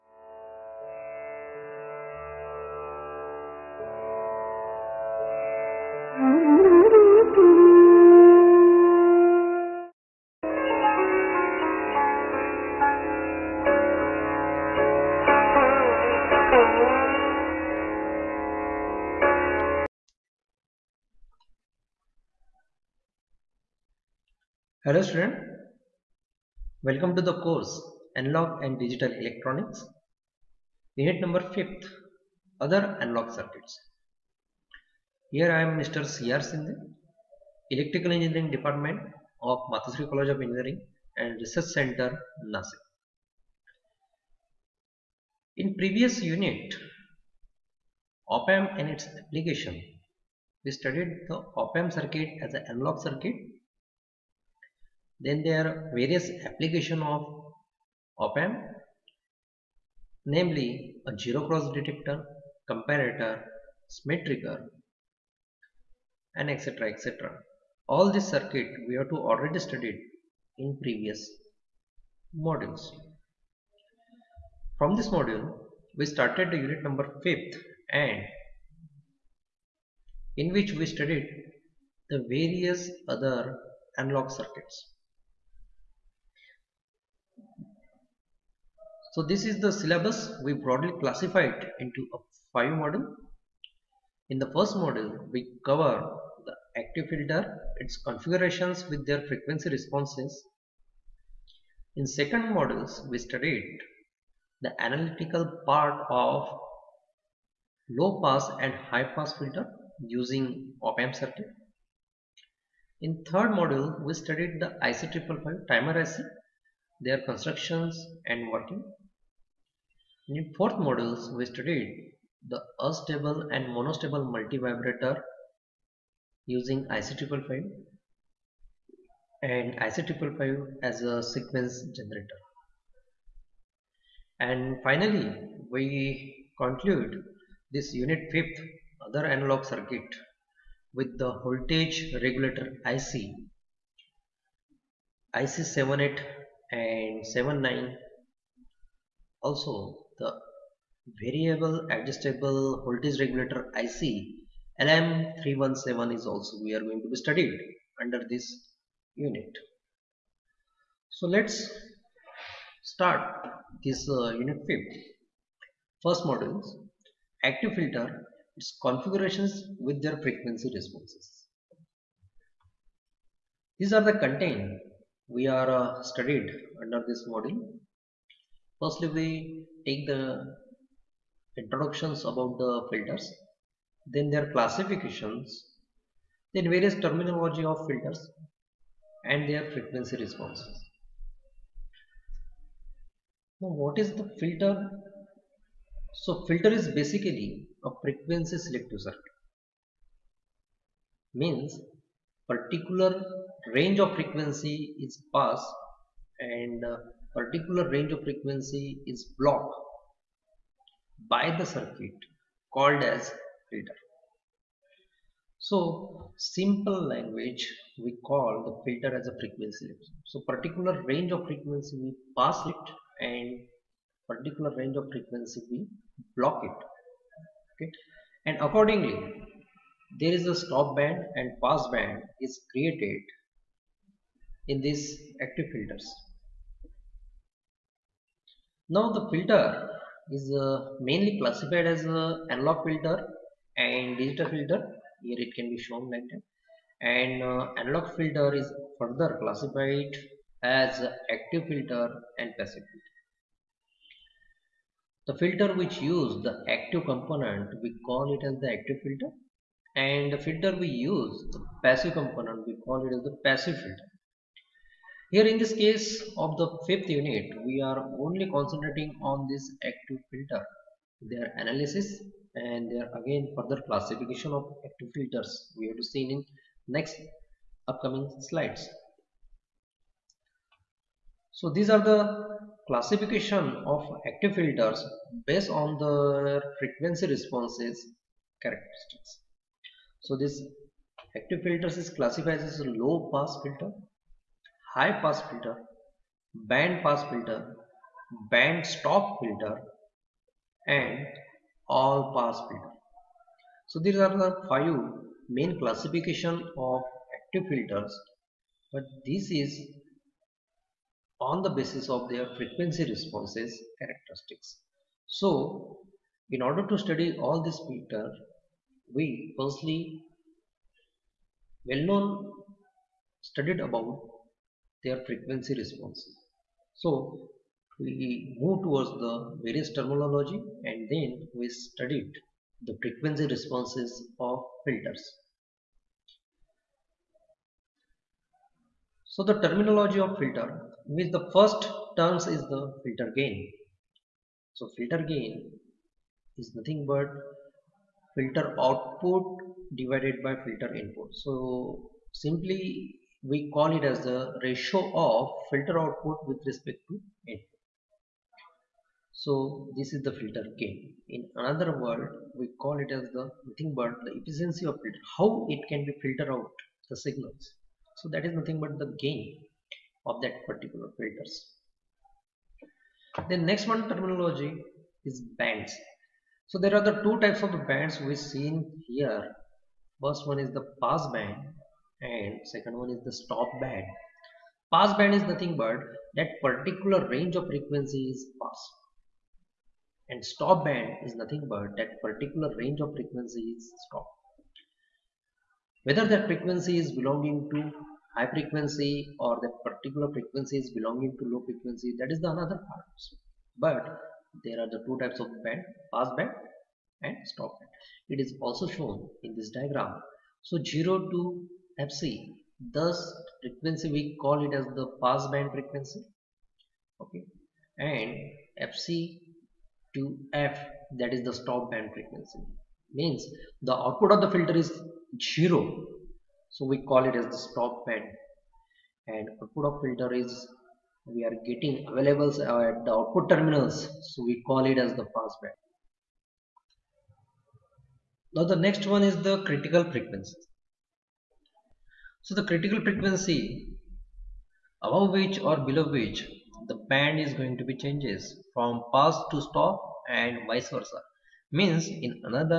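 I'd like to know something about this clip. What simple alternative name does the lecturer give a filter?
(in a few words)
frequency limit.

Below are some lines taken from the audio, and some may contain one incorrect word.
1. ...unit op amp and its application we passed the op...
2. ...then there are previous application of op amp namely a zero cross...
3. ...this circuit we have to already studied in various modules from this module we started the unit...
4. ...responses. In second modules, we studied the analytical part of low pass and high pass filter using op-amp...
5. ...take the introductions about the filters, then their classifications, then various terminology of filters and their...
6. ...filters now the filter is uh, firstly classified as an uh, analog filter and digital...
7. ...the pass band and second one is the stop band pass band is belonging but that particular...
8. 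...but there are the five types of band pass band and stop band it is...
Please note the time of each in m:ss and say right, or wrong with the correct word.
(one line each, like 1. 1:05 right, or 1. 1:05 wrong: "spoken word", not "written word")
1. 0:46 wrong: "studied", not "passed"
2. 0:55 wrong: "various", not "previous"
3. 1:08 wrong: "previous", not "various"
4. 1:39 right
5. 2:59 right
6. 3:55 wrong: "mainly", not "firstly"
7. 6:20 wrong: "nothing", not "belonging"
8. 6:43 wrong: "two", not "five".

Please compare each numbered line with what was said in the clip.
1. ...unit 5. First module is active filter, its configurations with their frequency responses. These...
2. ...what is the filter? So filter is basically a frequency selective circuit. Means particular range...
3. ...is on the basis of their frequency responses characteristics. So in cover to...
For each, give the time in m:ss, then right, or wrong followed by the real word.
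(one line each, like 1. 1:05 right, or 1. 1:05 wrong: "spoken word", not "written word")
1. 2:44 right
2. 3:13 right
3. 5:09 wrong: "order", not "cover".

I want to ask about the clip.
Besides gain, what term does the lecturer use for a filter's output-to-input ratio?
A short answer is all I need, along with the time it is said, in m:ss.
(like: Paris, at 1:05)
efficiency, at 6:04.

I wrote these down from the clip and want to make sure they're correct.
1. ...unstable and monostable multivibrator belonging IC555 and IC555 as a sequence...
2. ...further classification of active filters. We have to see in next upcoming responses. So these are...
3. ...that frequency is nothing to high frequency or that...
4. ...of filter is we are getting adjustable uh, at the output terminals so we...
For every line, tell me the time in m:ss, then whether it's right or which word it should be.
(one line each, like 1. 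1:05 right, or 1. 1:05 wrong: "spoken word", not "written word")
1. 2:02 wrong: "using", not "belonging"
2. 4:33 wrong: "slides", not "responses"
3. 6:36 wrong: "belonging", not "nothing"
4. 7:09 wrong: "available", not "adjustable".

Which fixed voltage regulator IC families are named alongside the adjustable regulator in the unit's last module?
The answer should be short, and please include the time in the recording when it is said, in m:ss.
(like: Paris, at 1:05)
78 and 79, at 2:25.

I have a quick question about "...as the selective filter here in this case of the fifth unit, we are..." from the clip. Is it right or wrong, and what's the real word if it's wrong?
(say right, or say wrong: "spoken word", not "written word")
wrong: "passive", not "selective".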